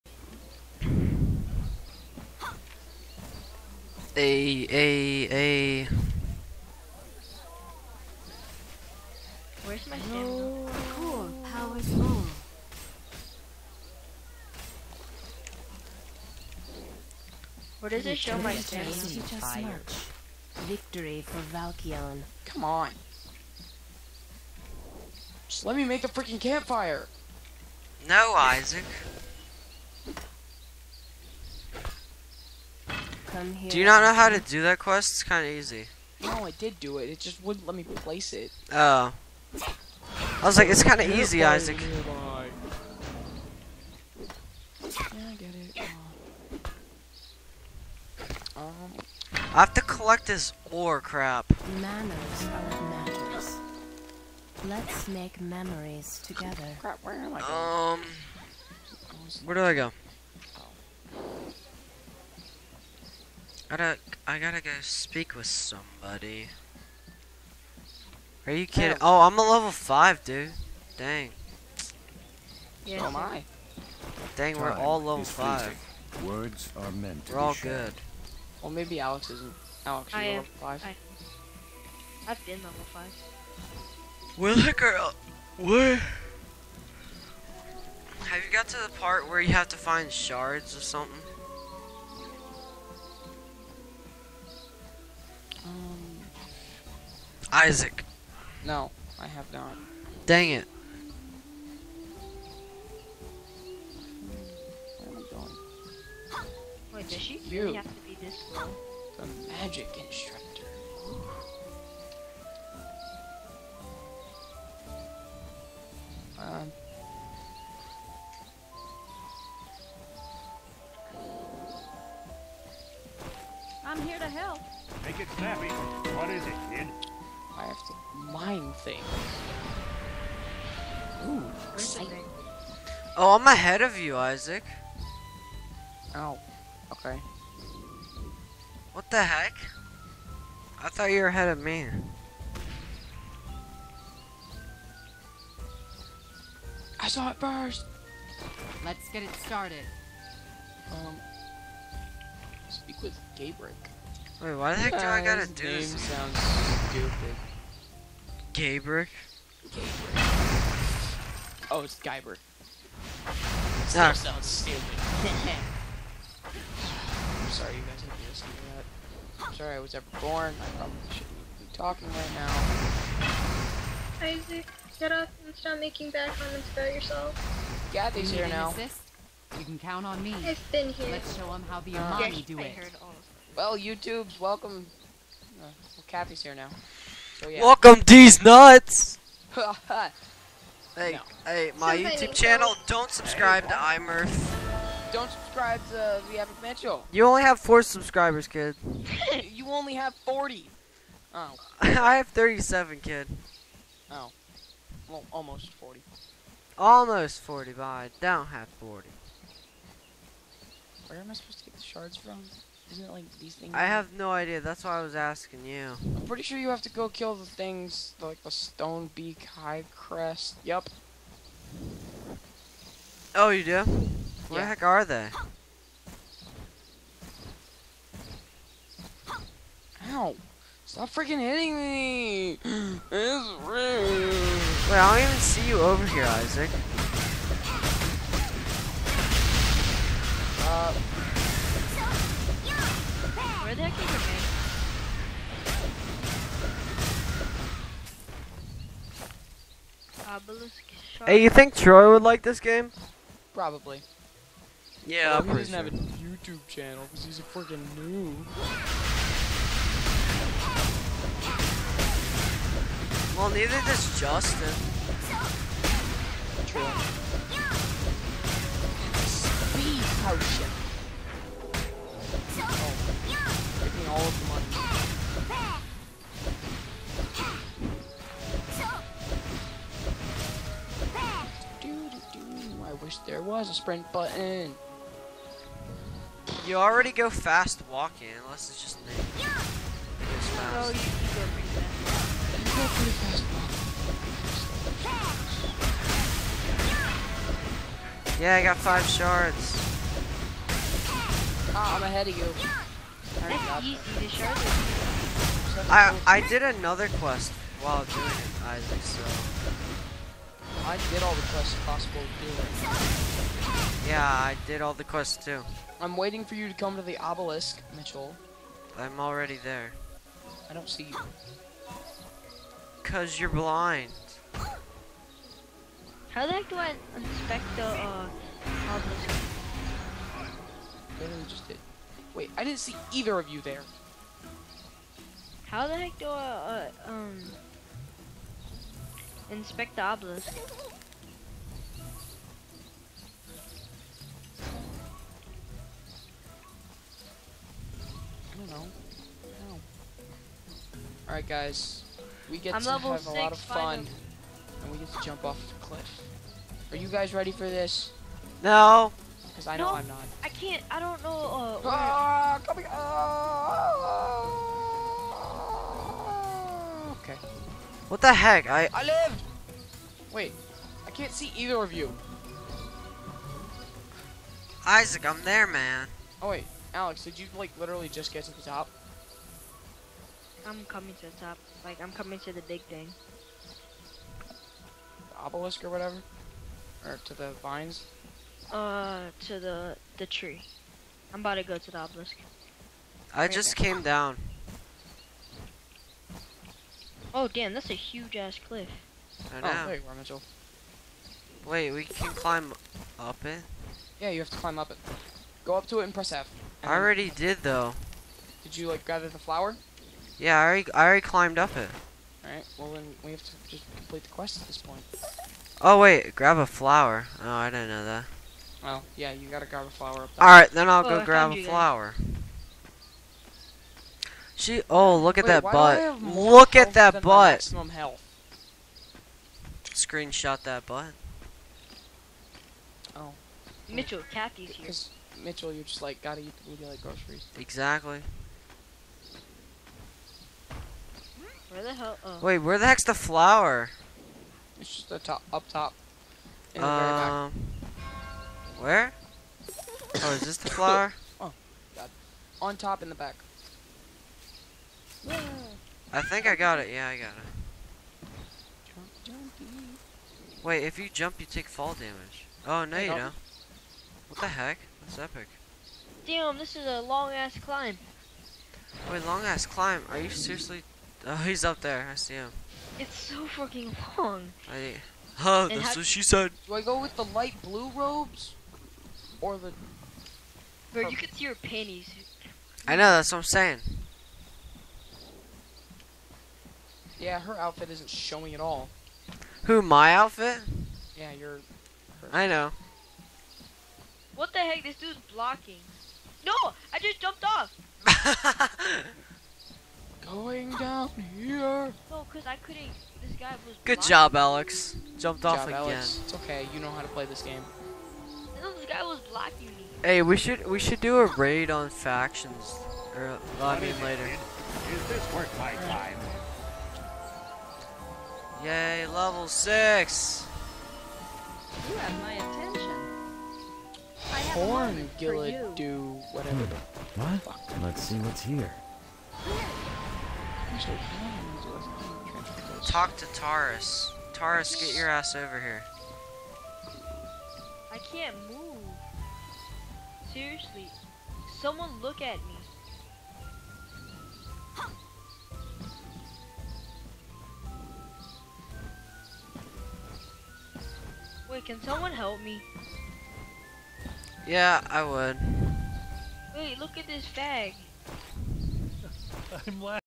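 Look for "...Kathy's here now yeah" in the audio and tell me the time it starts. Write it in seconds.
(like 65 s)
186 s.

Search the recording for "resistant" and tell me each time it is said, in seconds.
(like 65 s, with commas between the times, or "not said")
not said.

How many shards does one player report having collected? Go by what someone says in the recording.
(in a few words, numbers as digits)
5.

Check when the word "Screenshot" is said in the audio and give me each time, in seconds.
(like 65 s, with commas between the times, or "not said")
429 s.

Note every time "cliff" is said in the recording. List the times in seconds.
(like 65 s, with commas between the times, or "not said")
355 s, 398 s.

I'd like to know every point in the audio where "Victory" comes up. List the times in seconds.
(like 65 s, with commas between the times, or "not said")
20 s.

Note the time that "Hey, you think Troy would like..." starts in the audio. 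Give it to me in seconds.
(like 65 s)
251 s.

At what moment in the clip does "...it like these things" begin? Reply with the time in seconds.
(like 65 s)
213 s.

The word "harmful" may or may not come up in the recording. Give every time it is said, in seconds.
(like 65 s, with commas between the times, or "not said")
not said.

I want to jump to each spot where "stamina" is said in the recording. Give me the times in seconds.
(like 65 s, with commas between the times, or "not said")
9 s, 18 s.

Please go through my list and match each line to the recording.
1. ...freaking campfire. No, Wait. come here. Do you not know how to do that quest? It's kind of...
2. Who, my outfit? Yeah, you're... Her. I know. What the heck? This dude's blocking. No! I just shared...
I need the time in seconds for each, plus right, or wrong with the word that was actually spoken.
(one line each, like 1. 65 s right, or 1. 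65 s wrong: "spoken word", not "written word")
1. 26 s wrong: "Isaac", not "Wait"
2. 489 s wrong: "jumped", not "shared".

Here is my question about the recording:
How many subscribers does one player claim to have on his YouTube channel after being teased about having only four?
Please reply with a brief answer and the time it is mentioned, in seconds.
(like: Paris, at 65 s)
37, at 202 s.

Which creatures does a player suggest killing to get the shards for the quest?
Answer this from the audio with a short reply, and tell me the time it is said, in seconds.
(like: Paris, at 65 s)
stone beak high crest, at 218 s.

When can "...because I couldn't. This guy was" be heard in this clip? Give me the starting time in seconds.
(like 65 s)
502 s.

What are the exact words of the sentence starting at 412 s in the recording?
Alright, well then we have to just complete the quest at this point.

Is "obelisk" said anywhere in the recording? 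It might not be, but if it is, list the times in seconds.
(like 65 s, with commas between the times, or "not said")
317 s, 328 s, 340 s, 385 s, 391 s.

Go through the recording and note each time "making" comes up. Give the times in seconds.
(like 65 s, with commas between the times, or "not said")
175 s.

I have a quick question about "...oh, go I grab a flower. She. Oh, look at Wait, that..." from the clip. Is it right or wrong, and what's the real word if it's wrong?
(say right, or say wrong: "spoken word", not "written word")
right.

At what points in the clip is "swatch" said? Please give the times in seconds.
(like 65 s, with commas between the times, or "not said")
not said.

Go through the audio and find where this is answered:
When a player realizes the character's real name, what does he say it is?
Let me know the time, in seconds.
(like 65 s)
161 s.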